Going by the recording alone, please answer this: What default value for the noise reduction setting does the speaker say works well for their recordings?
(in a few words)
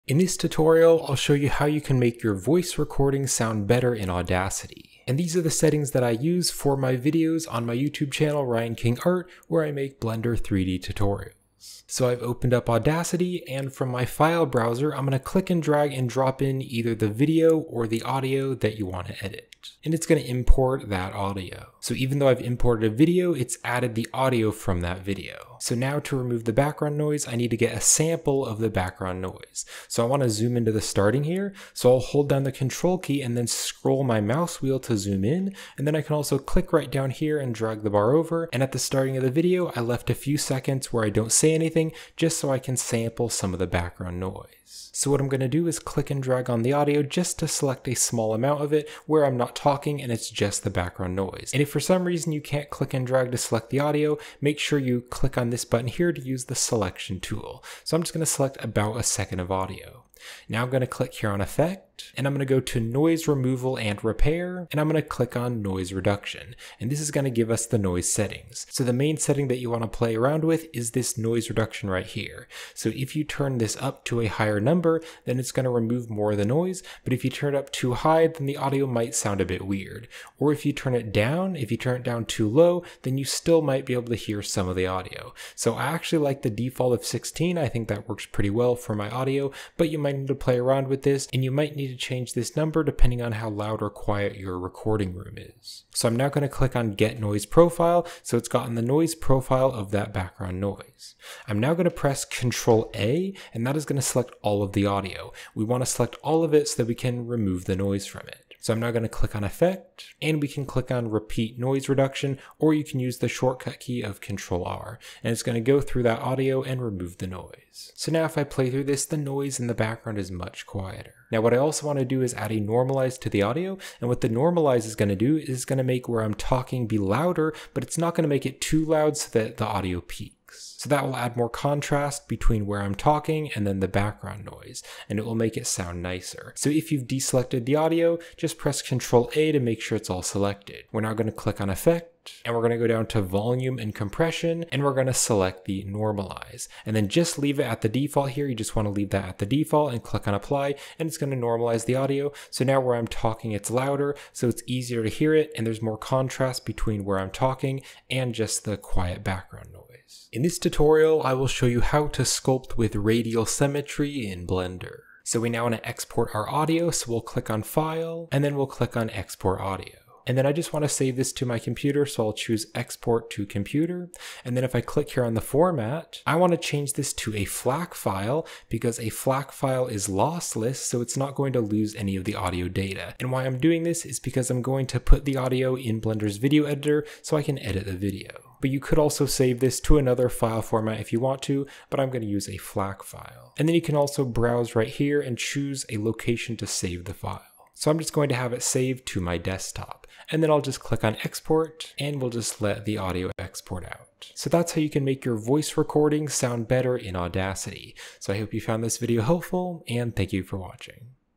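16.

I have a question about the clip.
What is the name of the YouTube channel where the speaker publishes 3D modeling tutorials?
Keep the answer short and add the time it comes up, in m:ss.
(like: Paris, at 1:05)
Ryan King Art, at 0:08.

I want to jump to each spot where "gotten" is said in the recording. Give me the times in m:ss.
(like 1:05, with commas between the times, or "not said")
1:38.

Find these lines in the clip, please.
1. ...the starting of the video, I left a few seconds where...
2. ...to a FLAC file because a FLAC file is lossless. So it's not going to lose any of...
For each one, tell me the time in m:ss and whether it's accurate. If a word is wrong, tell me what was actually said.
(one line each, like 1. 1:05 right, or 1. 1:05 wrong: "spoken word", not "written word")
1. 0:38 right
2. 2:57 right.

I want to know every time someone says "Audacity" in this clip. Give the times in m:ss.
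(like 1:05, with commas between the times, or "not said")
0:04, 0:12, 3:27.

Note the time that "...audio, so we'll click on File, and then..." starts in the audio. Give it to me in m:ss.
2:46.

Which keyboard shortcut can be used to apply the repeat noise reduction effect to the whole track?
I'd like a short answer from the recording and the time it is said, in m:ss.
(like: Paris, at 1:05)
Control R, at 1:54.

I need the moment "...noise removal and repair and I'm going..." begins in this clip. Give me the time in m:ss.
1:02.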